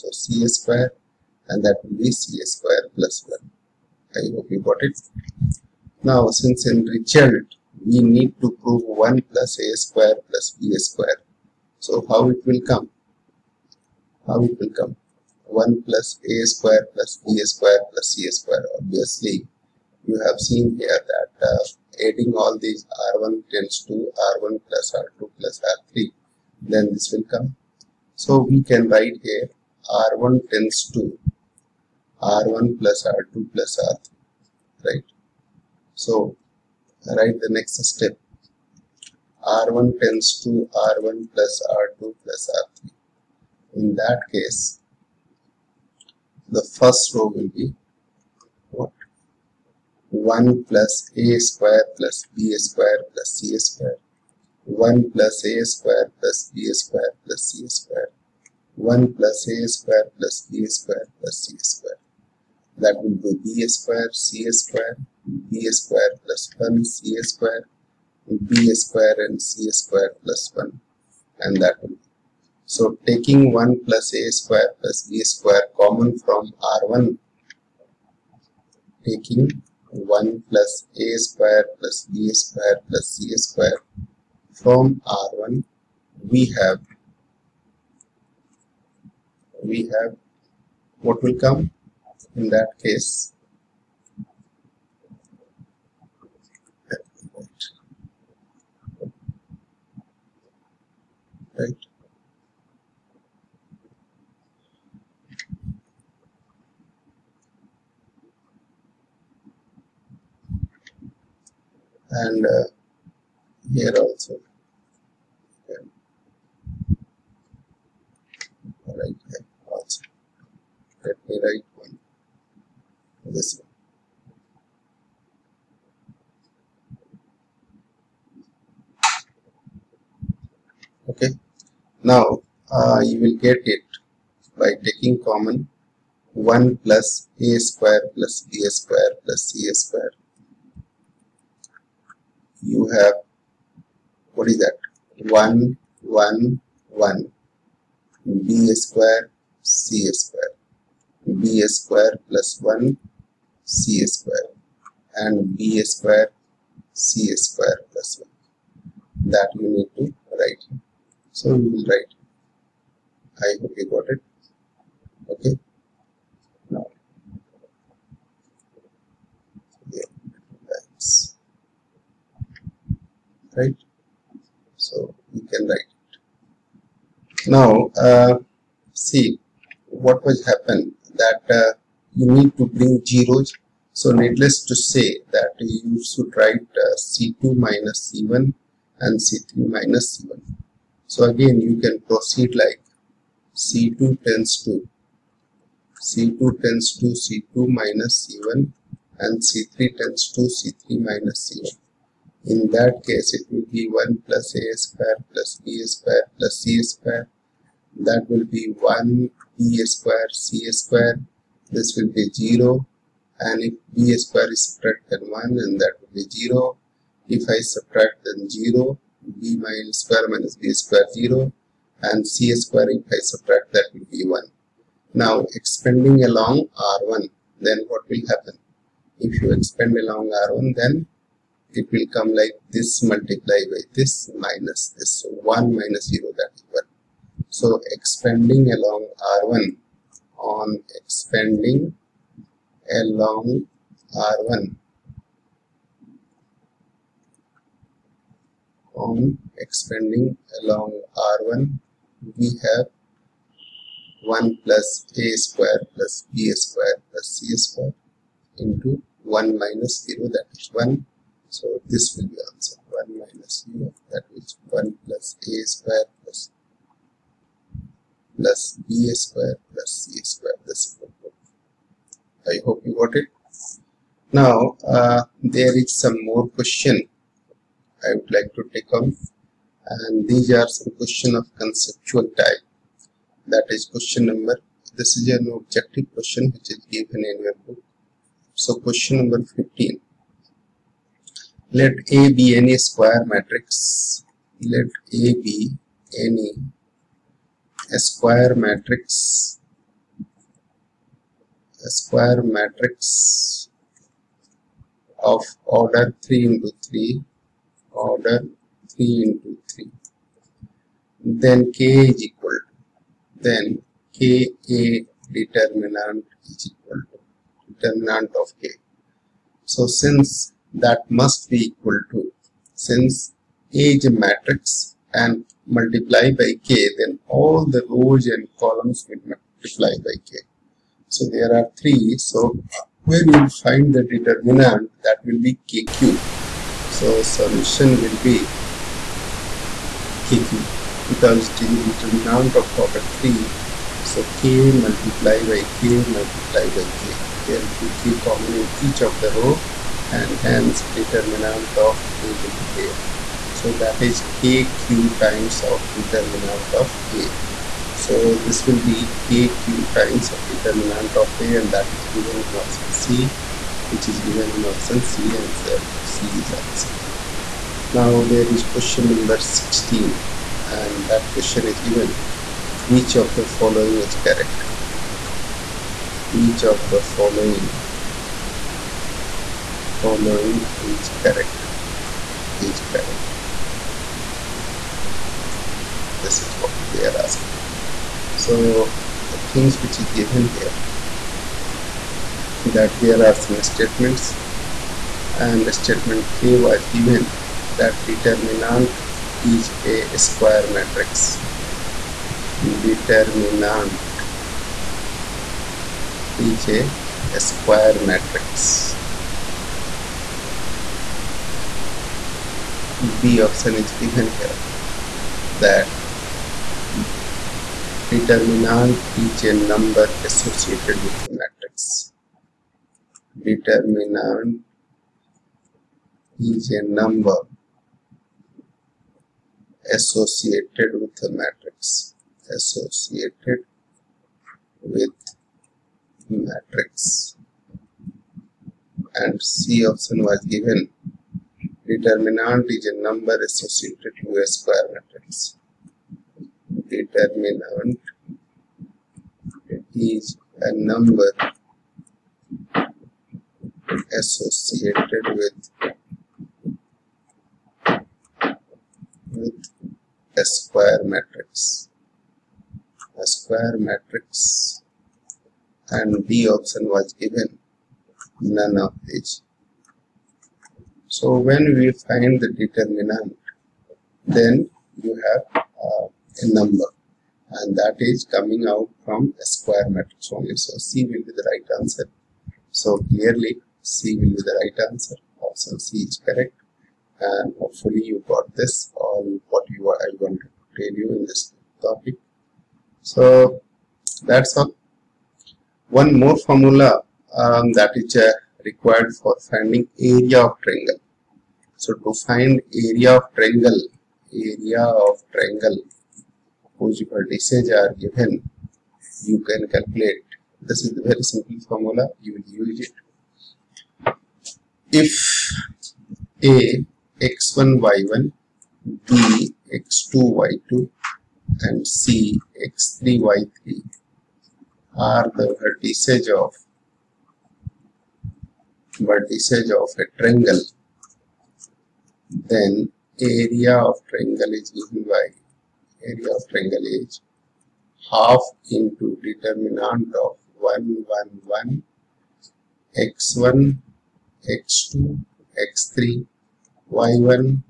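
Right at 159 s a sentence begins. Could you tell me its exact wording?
That you need to write so you will write.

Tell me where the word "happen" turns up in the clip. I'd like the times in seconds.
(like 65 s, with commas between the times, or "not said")
180 s, 228 s.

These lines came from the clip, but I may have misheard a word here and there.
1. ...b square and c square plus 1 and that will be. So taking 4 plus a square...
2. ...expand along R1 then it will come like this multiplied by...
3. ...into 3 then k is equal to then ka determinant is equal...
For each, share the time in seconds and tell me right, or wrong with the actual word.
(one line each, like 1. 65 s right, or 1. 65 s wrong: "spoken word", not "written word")
1. 68 s wrong: "1", not "4"
2. 229 s right
3. 309 s right.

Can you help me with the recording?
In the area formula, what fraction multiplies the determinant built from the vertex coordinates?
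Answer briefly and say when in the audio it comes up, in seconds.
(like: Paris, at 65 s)
Half, at 538 s.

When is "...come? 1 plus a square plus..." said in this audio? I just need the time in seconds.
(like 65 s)
14 s.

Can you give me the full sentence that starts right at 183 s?
So needless to say that you should write uh, C2 minus C1 and C3 minus C1.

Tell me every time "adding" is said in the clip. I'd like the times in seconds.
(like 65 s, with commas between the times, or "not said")
22 s.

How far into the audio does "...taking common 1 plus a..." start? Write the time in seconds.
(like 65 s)
134 s.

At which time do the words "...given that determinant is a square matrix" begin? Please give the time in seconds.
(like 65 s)
396 s.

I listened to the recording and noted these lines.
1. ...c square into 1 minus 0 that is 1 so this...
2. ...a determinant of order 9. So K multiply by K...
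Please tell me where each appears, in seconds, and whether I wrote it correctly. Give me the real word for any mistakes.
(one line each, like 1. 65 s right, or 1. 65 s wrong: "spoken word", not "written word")
1. 257 s right
2. 341 s wrong: "3", not "9".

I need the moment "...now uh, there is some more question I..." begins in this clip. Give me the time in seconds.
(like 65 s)
274 s.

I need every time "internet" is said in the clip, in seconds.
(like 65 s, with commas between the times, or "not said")
not said.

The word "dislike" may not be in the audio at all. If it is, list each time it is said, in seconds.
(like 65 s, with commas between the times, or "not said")
not said.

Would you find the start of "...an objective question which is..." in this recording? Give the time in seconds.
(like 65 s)
285 s.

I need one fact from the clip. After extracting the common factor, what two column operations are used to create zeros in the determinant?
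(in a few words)
C2 − C1 and C3 − C1.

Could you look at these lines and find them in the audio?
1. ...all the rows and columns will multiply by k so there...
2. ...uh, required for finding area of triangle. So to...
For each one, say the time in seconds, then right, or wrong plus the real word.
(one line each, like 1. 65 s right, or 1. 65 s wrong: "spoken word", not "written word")
1. 327 s right
2. 498 s right.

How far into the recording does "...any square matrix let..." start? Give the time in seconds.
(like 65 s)
292 s.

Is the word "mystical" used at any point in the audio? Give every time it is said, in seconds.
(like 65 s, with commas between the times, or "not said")
not said.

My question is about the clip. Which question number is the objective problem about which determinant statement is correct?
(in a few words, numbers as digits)
16.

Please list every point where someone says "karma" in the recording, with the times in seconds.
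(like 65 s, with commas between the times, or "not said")
not said.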